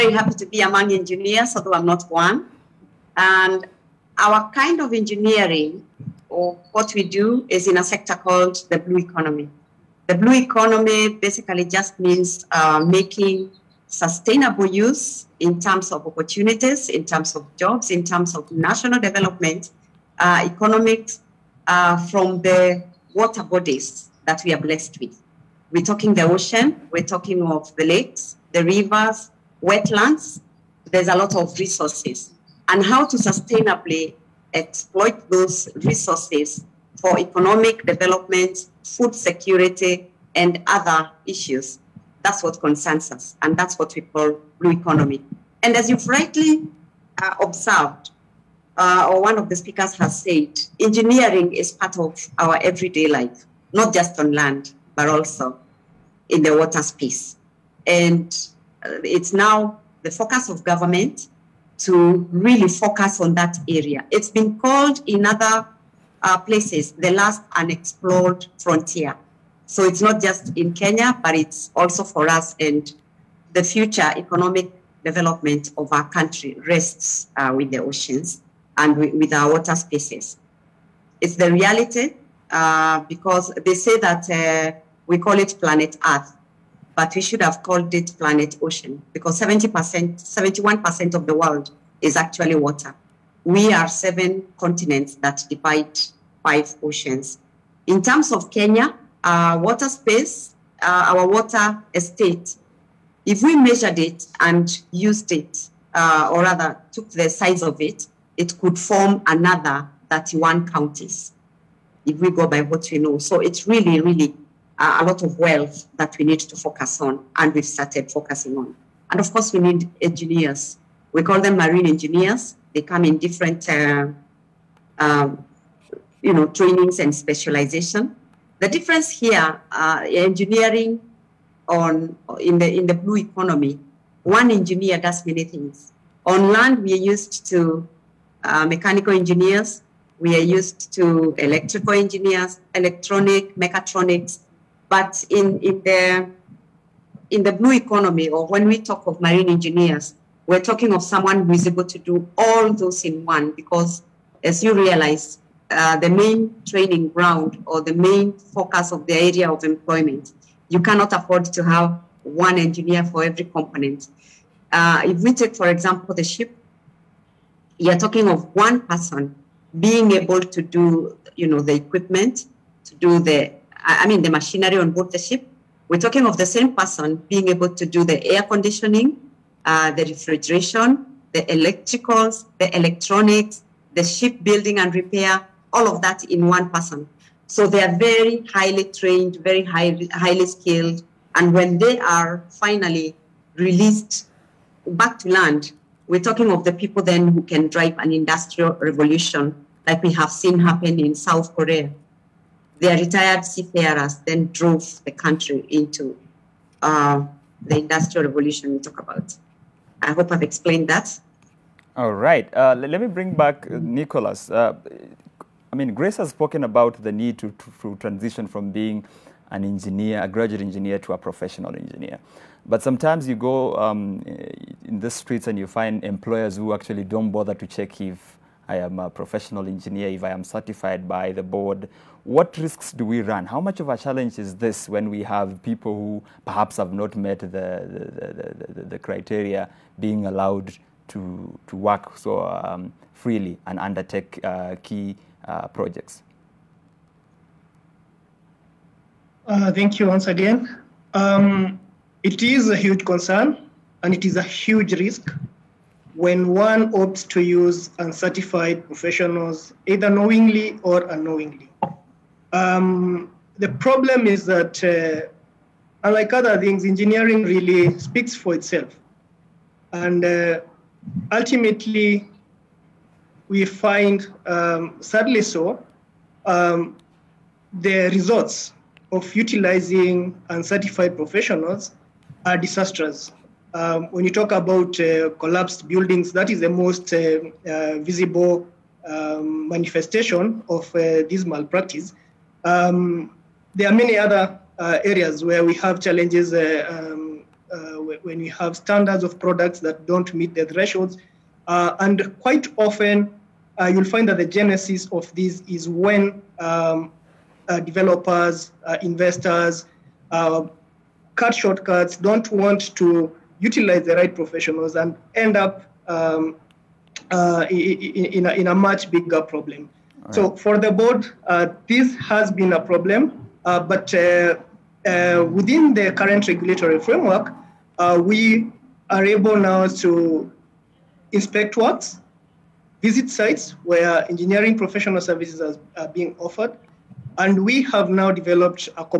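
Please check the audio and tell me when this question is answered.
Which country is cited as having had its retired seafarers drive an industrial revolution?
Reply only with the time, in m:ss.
3:21.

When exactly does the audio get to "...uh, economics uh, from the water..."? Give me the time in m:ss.
0:20.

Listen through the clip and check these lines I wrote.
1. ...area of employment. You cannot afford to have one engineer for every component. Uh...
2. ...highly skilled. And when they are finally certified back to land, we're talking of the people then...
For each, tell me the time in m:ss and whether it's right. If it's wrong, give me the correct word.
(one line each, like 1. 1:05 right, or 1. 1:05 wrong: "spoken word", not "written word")
1. 2:39 right
2. 3:10 wrong: "released", not "certified".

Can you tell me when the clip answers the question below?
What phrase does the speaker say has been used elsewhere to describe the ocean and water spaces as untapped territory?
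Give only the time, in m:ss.
1:06.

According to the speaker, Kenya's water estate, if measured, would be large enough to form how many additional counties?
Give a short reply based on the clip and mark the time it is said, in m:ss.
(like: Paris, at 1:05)
31, at 1:50.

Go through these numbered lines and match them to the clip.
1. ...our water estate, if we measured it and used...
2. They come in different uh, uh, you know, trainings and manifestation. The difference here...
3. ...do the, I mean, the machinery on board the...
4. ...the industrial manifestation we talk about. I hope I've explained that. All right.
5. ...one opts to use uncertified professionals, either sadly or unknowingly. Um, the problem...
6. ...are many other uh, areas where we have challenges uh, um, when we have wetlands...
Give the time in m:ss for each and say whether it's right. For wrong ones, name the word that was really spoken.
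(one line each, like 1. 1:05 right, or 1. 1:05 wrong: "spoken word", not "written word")
1. 1:41 right
2. 2:02 wrong: "specialization", not "manifestation"
3. 2:52 right
4. 3:27 wrong: "revolution", not "manifestation"
5. 4:16 wrong: "knowingly", not "sadly"
6. 4:53 wrong: "standards", not "wetlands".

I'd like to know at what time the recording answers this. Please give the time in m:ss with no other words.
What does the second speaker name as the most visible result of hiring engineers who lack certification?
4:45.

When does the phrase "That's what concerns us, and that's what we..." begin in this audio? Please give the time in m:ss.
0:42.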